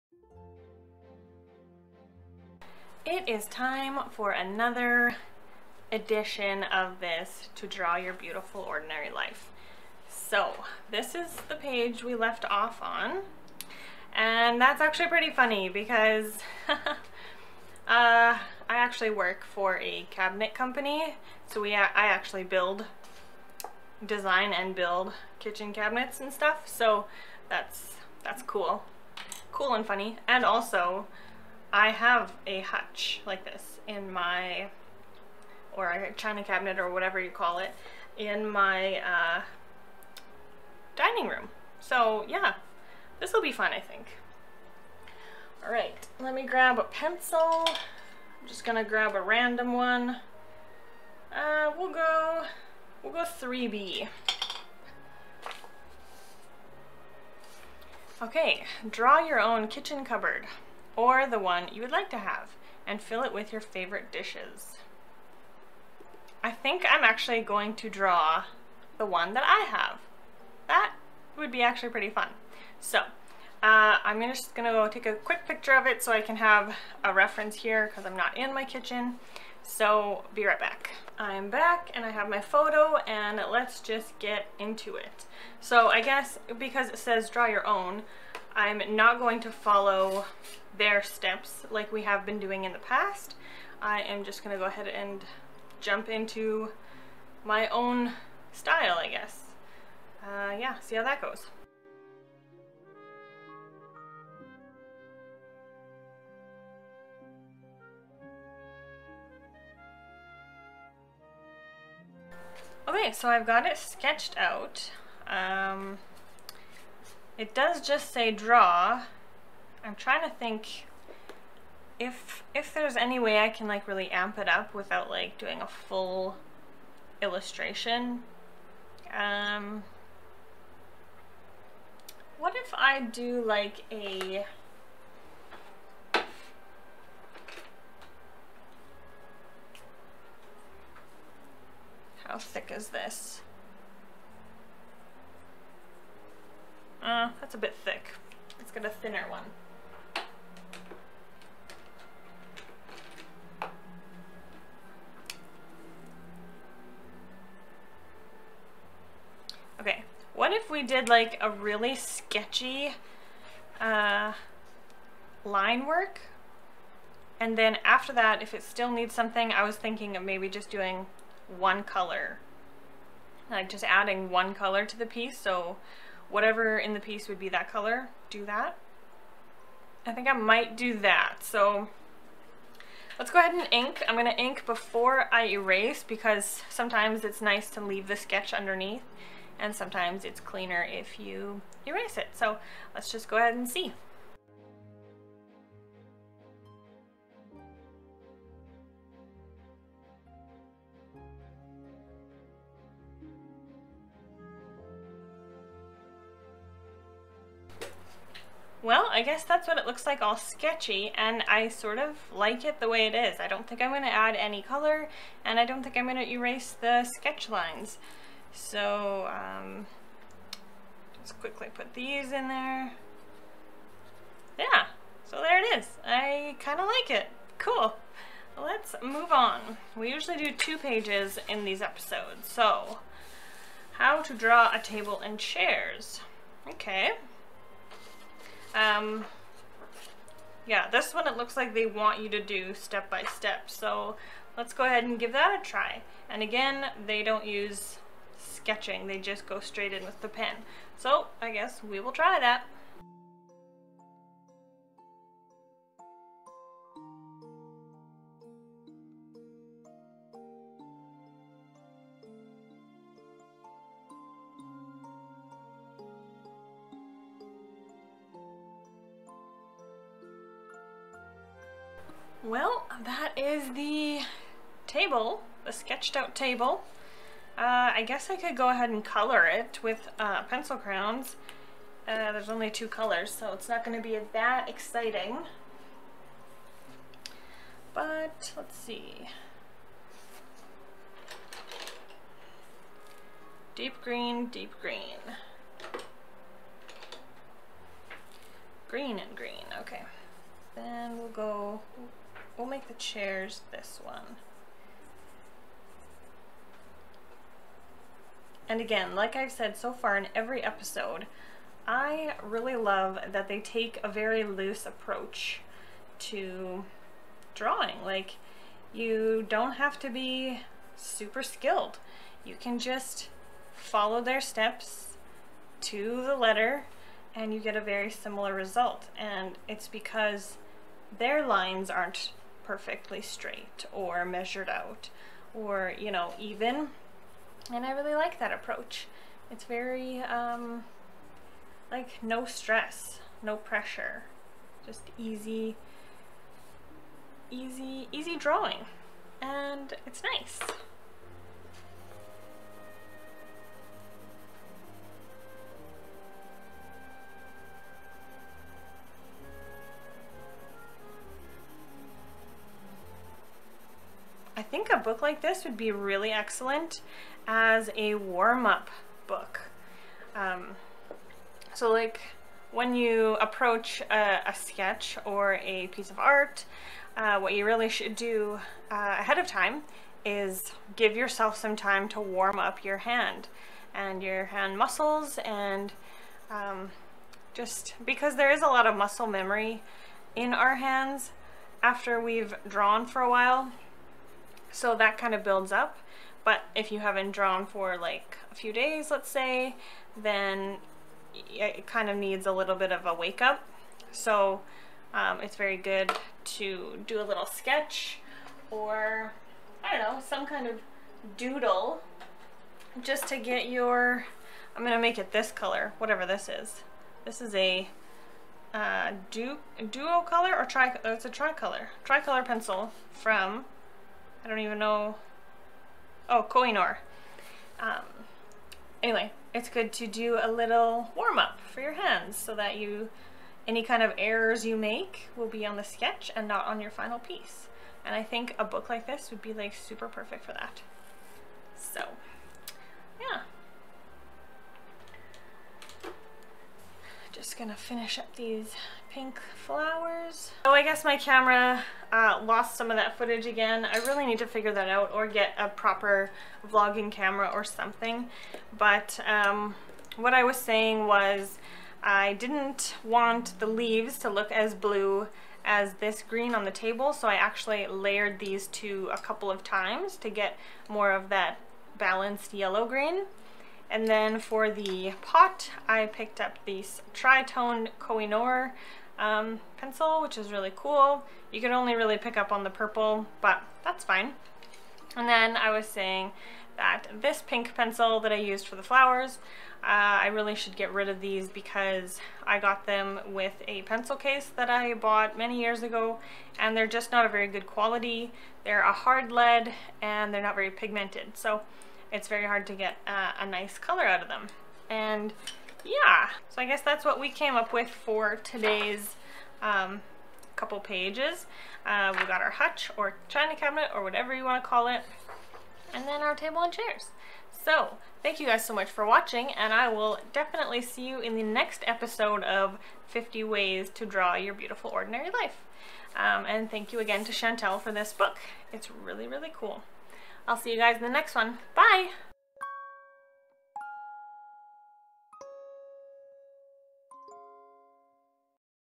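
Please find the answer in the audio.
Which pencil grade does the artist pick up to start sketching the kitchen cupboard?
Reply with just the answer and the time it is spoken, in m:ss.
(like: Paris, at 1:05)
3B, at 0:53.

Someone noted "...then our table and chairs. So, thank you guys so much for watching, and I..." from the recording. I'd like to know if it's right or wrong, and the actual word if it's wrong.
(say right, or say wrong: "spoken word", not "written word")
right.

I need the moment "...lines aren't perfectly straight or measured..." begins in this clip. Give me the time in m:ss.
5:31.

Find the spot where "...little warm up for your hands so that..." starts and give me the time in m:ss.
7:10.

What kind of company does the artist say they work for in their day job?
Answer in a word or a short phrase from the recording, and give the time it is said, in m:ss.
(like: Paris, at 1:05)
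Cabinet company, at 0:20.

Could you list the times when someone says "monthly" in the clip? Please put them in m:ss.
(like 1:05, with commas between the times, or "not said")
not said.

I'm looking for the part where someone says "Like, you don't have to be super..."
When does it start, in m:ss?
5:18.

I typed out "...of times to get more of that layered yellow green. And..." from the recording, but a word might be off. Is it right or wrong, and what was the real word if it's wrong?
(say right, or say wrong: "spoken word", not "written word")
wrong: "balanced", not "layered".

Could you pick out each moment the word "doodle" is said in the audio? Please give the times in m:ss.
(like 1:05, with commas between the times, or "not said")
6:51.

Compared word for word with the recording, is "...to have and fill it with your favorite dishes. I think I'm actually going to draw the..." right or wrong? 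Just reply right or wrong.
right.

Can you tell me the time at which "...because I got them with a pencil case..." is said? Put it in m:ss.
8:11.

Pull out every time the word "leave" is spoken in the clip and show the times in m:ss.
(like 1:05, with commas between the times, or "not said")
3:07, 7:43.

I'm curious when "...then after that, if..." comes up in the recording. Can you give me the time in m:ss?
2:47.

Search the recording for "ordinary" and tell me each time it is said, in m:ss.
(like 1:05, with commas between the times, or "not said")
0:08, 8:44.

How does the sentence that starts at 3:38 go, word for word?
So, um, just quickly put these in there.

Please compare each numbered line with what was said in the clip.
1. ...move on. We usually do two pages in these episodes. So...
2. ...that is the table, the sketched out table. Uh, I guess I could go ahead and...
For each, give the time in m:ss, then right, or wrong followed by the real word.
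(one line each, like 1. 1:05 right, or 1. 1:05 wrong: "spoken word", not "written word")
1. 3:49 right
2. 4:33 right.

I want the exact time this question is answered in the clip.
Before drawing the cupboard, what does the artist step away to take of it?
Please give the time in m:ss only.
1:15.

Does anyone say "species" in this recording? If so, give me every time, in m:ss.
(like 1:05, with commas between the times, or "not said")
not said.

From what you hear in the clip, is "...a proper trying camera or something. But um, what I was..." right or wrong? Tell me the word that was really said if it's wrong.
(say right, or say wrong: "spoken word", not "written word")
wrong: "vlogging", not "trying".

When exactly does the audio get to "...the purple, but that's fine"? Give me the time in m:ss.
8:02.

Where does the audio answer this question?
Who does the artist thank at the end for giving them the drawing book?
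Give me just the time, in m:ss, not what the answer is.
8:47.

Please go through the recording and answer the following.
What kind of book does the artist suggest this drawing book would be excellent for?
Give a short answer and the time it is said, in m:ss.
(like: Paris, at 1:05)
A warm-up book, at 6:08.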